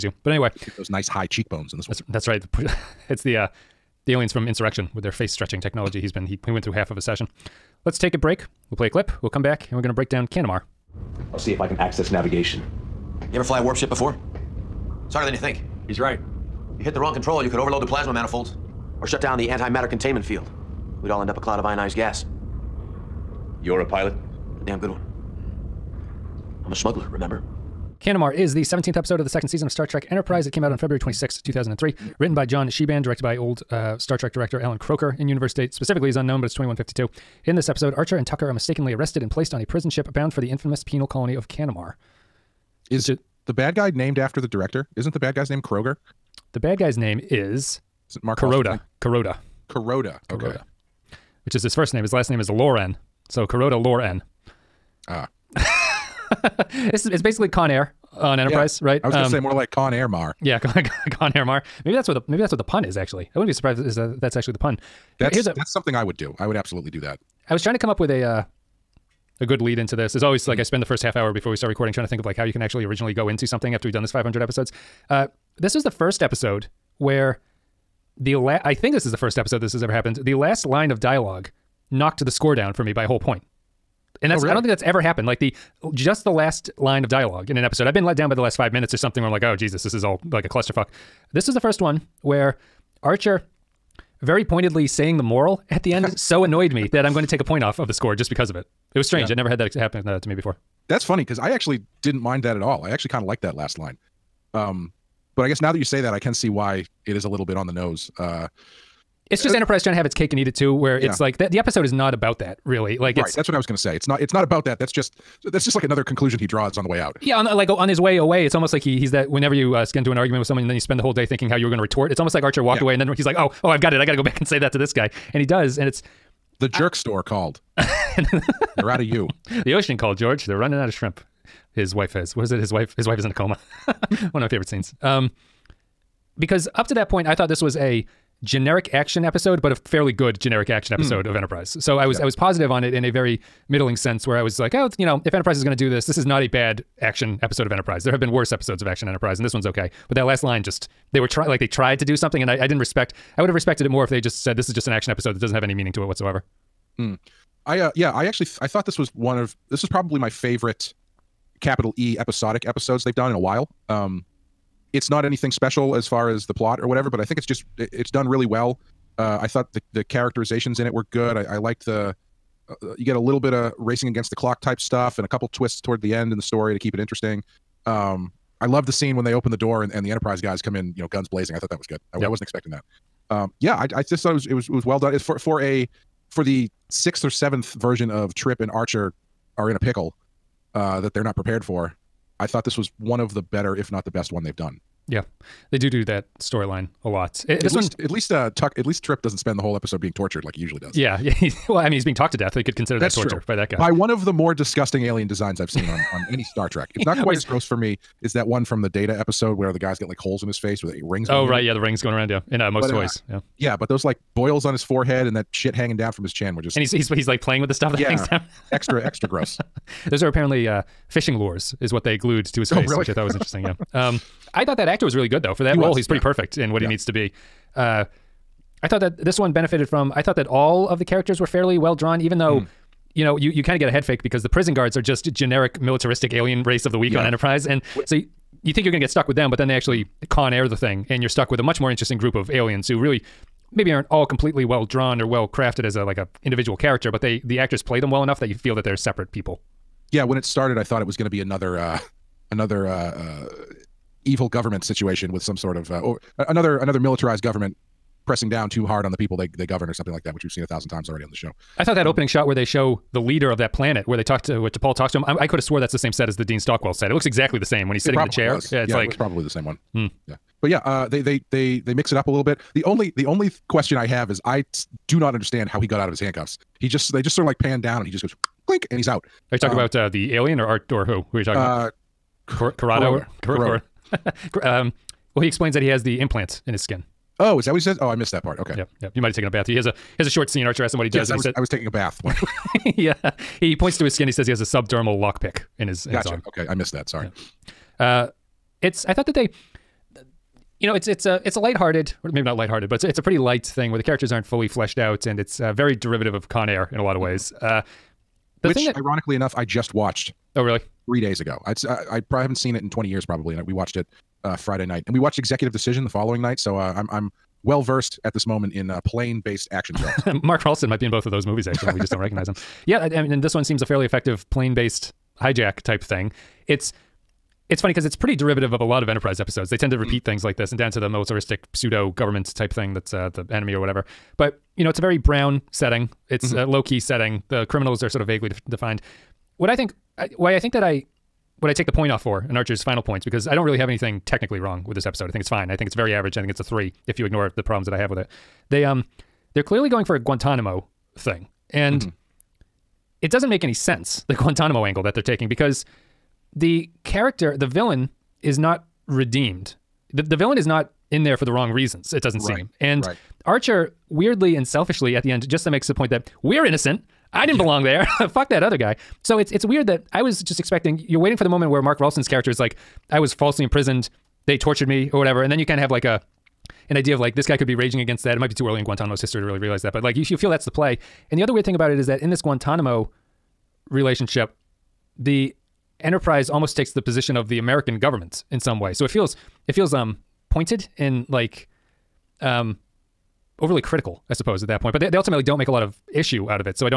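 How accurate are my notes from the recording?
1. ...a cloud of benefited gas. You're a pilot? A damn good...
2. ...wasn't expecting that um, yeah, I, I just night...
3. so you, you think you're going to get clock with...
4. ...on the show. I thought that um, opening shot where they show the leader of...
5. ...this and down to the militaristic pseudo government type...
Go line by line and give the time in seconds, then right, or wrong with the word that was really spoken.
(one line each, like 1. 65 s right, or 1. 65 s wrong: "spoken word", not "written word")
1. 21 s wrong: "ionized", not "benefited"
2. 182 s wrong: "thought", not "night"
3. 238 s wrong: "stuck", not "clock"
4. 261 s right
5. 330 s right.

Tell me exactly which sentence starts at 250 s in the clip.
Yeah, when it started, I thought it was going to be another.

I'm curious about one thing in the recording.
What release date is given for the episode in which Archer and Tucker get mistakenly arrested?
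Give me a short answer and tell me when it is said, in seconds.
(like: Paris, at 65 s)
February 26, 2003, at 30 s.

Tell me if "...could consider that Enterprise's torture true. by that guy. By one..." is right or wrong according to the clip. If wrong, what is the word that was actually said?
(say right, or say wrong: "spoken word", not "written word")
wrong: "That", not "Enterprise".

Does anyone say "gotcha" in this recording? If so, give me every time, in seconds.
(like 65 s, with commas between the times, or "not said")
296 s.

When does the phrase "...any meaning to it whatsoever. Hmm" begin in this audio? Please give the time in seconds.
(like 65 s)
155 s.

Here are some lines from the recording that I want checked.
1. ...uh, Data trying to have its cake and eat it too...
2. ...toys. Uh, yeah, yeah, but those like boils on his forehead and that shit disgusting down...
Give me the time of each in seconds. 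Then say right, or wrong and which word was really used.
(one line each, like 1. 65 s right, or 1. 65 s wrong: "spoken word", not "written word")
1. 109 s wrong: "Enterprise", not "Data"
2. 213 s wrong: "hanging", not "disgusting".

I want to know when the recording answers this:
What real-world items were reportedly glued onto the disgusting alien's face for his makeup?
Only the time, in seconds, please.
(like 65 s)
221 s.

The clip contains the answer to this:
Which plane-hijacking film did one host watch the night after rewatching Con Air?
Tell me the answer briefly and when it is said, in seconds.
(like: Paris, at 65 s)
Executive Decision, at 315 s.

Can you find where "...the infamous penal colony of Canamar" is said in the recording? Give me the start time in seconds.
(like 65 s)
40 s.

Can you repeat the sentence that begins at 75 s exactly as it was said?
Uh, this was the first episode where the la- I think this is the first episode this has ever happened.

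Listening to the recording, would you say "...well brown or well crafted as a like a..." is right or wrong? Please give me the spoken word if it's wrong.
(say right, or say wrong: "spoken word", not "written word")
wrong: "drawn", not "brown".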